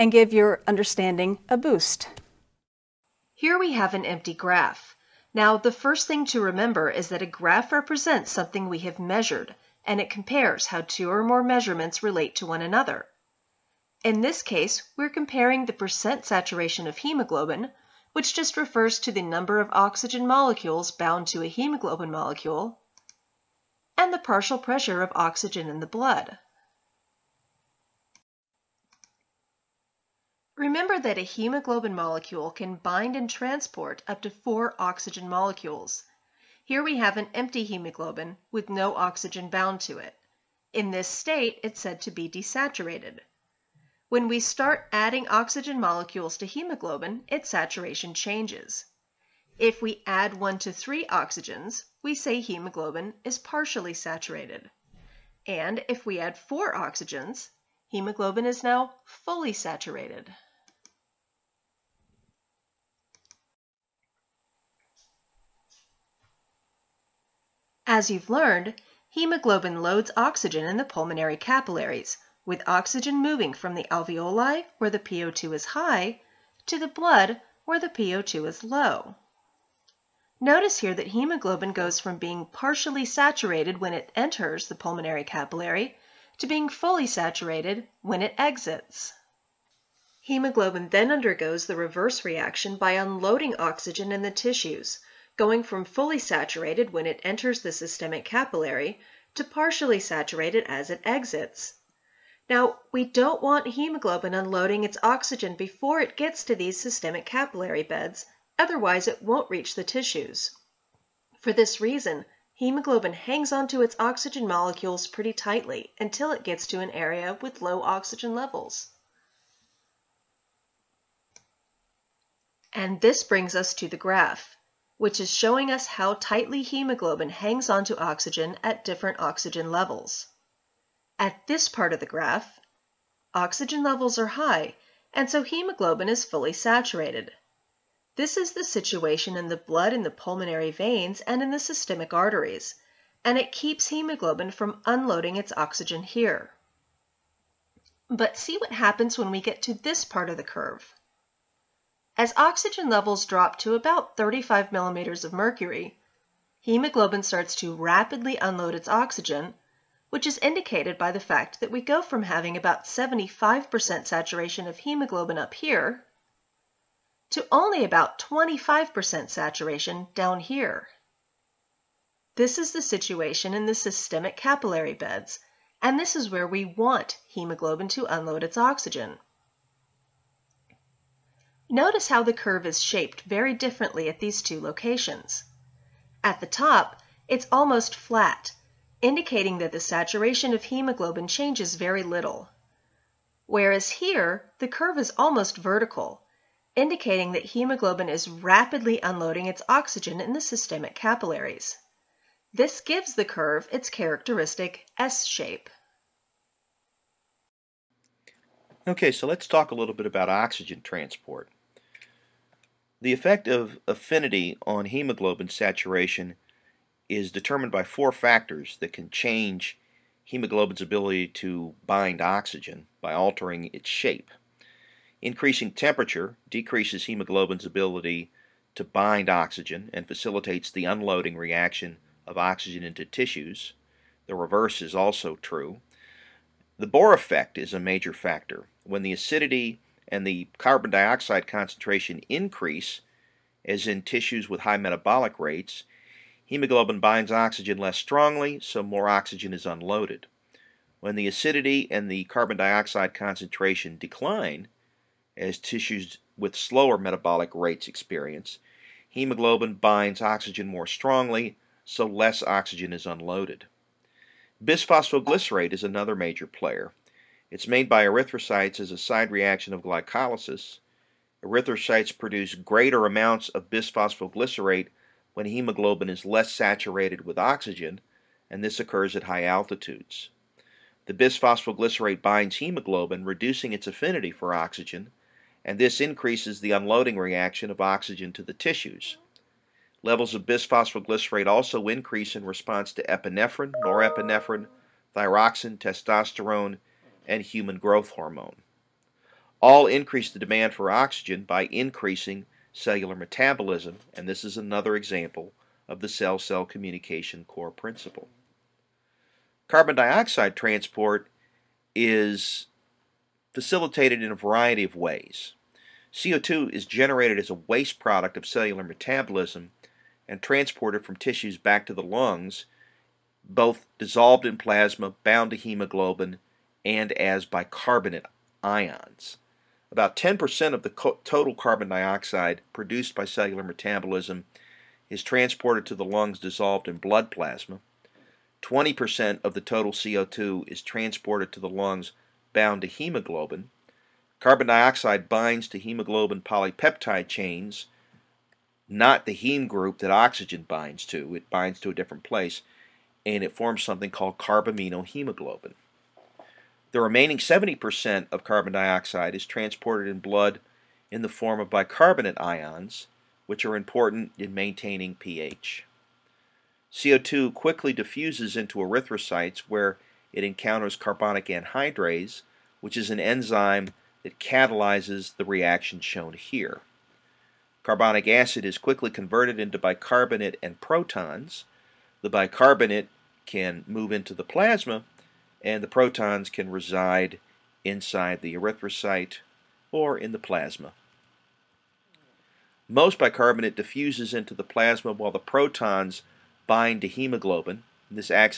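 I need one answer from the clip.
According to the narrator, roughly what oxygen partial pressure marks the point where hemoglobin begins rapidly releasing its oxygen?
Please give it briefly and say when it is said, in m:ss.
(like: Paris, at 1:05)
35 mmHg, at 2:34.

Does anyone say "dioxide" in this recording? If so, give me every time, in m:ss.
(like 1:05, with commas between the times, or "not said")
4:00, 4:12, 5:09, 5:31, 5:44, 5:58.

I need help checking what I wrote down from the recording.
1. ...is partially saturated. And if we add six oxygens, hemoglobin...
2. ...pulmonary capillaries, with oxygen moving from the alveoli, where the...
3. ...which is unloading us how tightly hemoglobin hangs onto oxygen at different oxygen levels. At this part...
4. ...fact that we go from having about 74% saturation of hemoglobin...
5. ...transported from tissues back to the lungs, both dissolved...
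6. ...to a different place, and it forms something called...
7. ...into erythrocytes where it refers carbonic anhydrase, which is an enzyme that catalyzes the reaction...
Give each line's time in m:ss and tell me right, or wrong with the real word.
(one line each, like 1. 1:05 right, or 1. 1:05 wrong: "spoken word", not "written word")
1. 0:53 wrong: "four", not "six"
2. 1:10 right
3. 2:04 wrong: "showing", not "unloading"
4. 2:41 wrong: "75", not "74"
5. 5:20 right
6. 5:51 right
7. 6:08 wrong: "encounters", not "refers".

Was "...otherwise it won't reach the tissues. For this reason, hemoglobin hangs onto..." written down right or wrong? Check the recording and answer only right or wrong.
right.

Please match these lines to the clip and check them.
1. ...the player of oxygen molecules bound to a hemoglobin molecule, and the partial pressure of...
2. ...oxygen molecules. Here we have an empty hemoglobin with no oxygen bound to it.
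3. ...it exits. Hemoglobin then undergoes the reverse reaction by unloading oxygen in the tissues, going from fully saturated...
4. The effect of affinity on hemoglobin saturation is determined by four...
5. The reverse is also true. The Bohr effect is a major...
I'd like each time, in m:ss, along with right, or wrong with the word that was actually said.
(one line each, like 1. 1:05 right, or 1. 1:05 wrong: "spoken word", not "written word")
1. 0:19 wrong: "number", not "player"
2. 0:34 right
3. 1:28 right
4. 3:33 right
5. 3:54 right.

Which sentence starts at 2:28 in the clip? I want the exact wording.
But see what happens when we get to this part of the curve.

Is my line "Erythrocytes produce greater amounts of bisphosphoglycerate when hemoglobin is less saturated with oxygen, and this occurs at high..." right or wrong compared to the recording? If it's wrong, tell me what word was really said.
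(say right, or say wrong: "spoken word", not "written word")
right.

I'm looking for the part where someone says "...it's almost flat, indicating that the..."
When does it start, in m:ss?
3:07.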